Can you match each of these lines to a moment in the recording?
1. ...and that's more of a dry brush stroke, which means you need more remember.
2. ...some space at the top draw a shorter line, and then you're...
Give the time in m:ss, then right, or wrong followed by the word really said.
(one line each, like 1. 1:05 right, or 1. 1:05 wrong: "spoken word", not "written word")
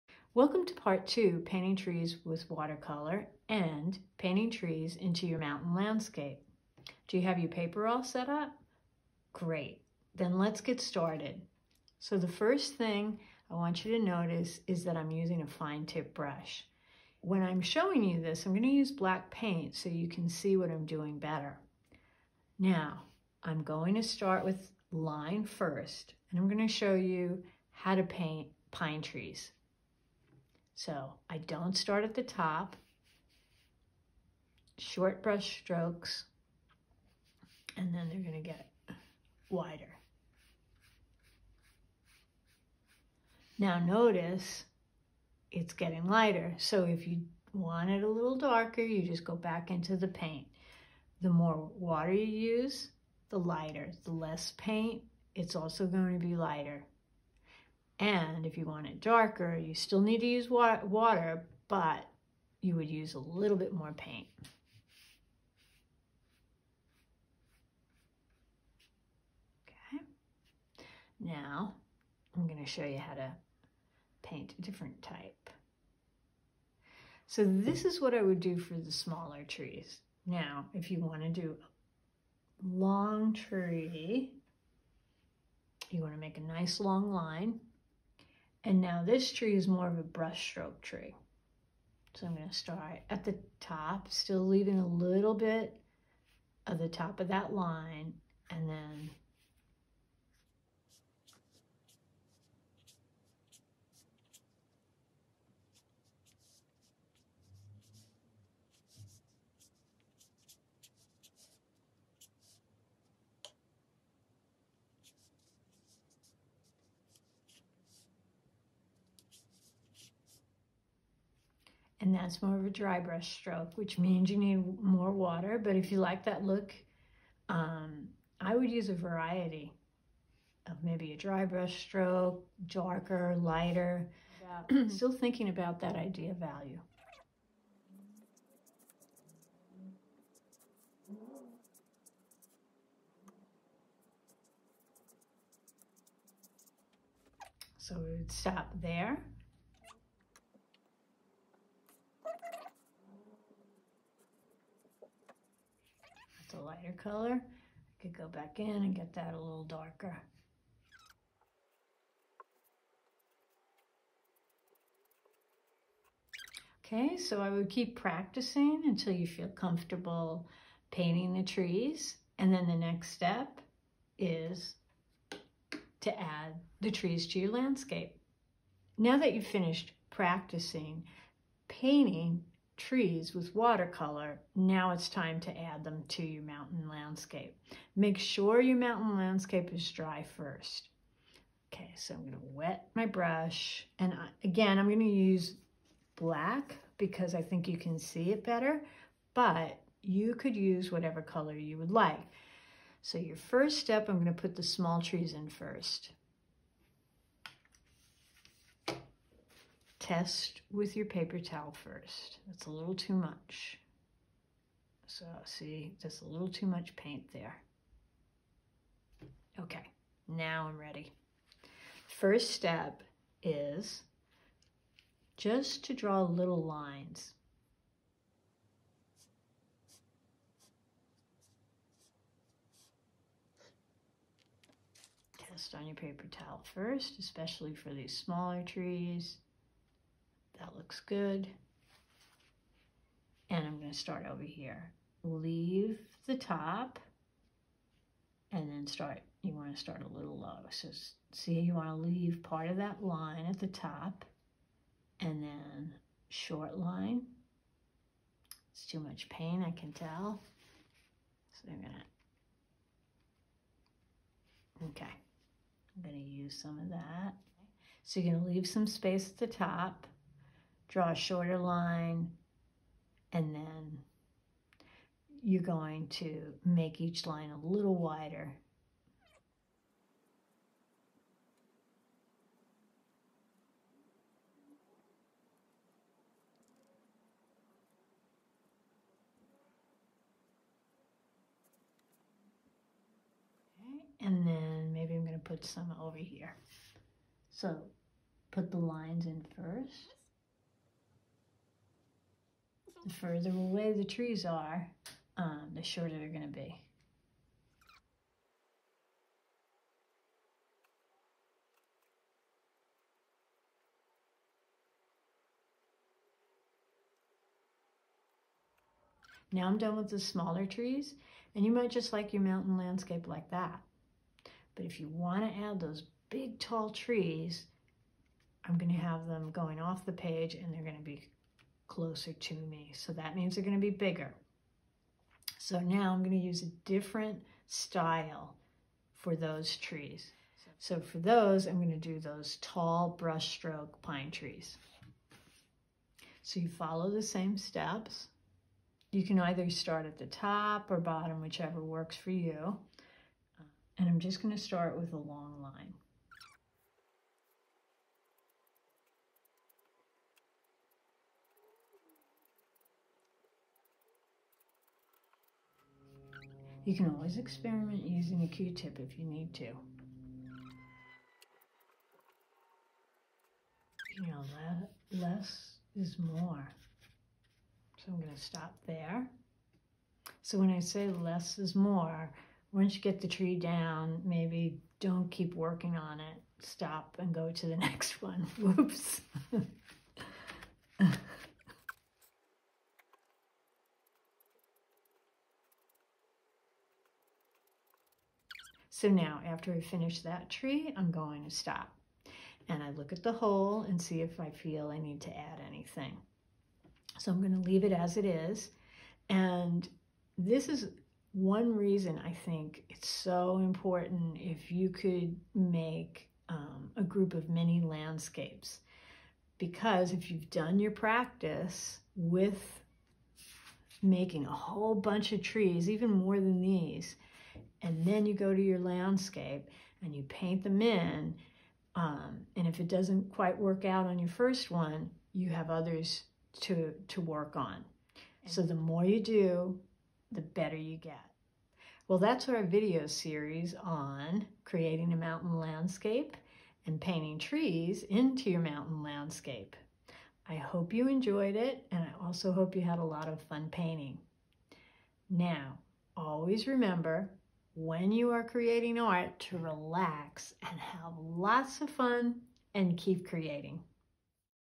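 1. 2:02 wrong: "water", not "remember"
2. 4:28 right.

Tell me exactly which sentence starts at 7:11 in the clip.
Um, and if it doesn't quite work out on your first one, you have others to, to work on.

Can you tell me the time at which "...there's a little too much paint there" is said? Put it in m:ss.
3:36.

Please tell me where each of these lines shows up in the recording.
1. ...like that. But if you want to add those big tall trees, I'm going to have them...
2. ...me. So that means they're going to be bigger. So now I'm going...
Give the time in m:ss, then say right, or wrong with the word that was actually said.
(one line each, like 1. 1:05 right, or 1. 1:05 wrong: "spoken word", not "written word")
1. 5:23 right
2. 5:32 right.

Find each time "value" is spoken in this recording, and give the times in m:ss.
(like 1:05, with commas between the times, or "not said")
2:16.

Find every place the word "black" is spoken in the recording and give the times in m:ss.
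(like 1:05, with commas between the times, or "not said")
0:18, 3:16.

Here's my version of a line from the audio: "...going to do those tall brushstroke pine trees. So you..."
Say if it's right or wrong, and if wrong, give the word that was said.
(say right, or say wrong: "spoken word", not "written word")
right.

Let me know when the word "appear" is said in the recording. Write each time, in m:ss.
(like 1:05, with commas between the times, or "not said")
not said.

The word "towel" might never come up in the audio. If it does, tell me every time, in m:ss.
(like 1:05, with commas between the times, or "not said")
3:31, 3:56.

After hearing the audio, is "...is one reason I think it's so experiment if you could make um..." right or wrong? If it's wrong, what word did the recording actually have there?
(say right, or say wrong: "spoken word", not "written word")
wrong: "important", not "experiment".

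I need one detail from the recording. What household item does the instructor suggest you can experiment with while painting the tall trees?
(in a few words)
A Q-tip.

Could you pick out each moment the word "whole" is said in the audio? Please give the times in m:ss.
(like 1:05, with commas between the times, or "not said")
6:43, 7:04.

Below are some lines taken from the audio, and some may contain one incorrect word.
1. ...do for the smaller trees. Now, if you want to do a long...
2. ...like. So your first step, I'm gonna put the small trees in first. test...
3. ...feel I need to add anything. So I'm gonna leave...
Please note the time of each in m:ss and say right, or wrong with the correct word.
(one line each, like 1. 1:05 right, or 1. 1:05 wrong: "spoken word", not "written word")
1. 1:18 right
2. 3:21 right
3. 6:44 right.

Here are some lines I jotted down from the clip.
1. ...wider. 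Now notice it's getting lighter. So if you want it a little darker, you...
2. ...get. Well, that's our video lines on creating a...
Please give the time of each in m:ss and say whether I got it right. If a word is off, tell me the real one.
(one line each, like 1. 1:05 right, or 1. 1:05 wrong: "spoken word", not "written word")
1. 0:39 right
2. 7:20 wrong: "series", not "lines".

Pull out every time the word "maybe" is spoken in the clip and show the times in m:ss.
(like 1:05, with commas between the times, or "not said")
2:10, 4:54, 6:24.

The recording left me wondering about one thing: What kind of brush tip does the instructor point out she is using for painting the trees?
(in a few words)
Fine tip.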